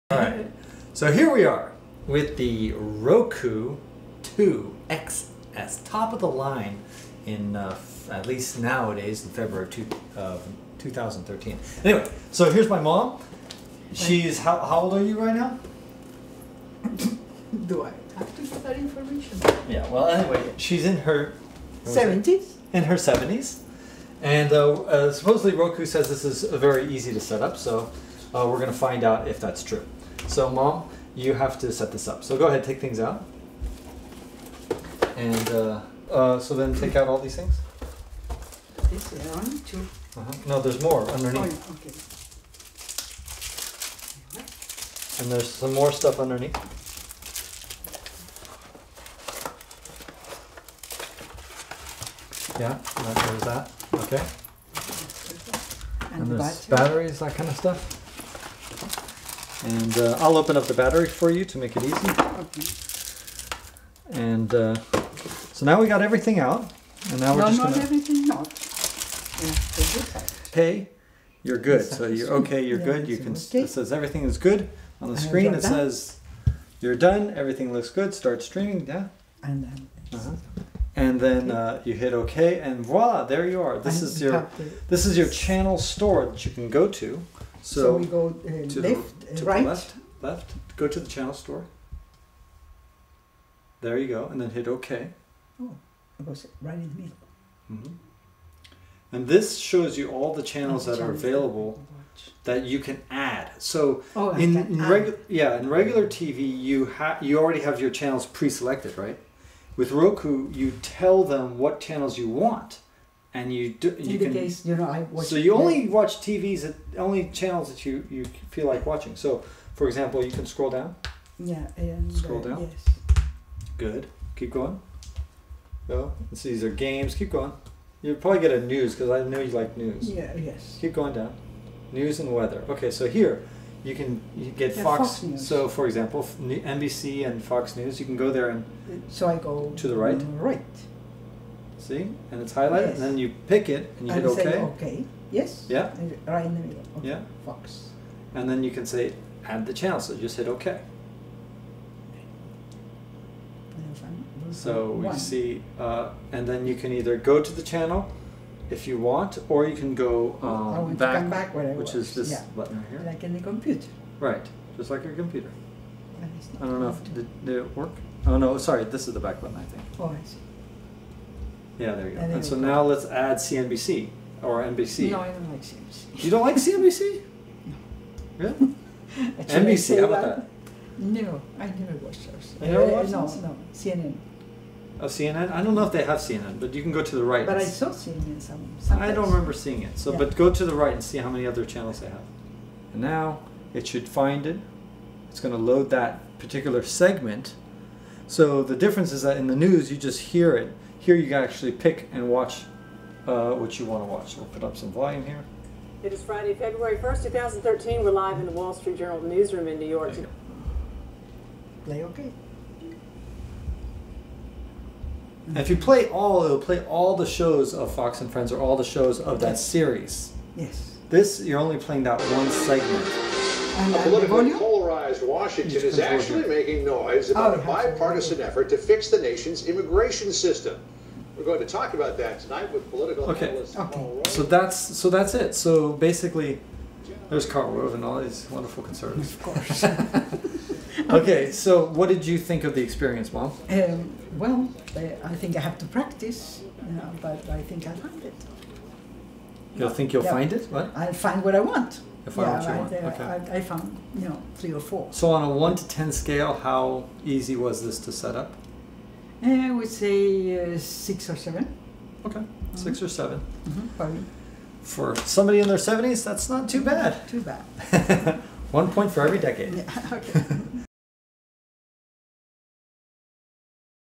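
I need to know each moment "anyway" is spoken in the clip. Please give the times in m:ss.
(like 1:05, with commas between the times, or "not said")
0:11, 0:20.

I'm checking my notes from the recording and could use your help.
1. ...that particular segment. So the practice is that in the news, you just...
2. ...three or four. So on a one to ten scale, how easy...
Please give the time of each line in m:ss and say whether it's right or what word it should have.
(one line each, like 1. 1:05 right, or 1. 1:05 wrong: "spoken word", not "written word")
1. 3:15 wrong: "difference", not "practice"
2. 4:14 right.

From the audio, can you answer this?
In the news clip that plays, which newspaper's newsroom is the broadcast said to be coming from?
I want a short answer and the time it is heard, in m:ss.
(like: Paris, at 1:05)
Wall Street Journal, at 3:28.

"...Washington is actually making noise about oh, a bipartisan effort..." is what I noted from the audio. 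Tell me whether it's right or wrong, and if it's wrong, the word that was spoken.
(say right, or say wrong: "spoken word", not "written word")
right.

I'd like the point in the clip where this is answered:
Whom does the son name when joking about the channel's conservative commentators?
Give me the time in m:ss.
3:57.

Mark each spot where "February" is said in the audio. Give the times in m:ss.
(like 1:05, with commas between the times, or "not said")
0:09, 3:26.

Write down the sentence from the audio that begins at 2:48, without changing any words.
Oh no, sorry, this is the back button, I think.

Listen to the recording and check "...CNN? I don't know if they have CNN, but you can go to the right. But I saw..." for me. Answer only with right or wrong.
right.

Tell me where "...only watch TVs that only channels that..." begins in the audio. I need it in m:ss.
1:55.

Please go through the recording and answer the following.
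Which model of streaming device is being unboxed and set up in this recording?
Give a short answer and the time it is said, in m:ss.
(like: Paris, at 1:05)
Roku 2 XS, at 0:02.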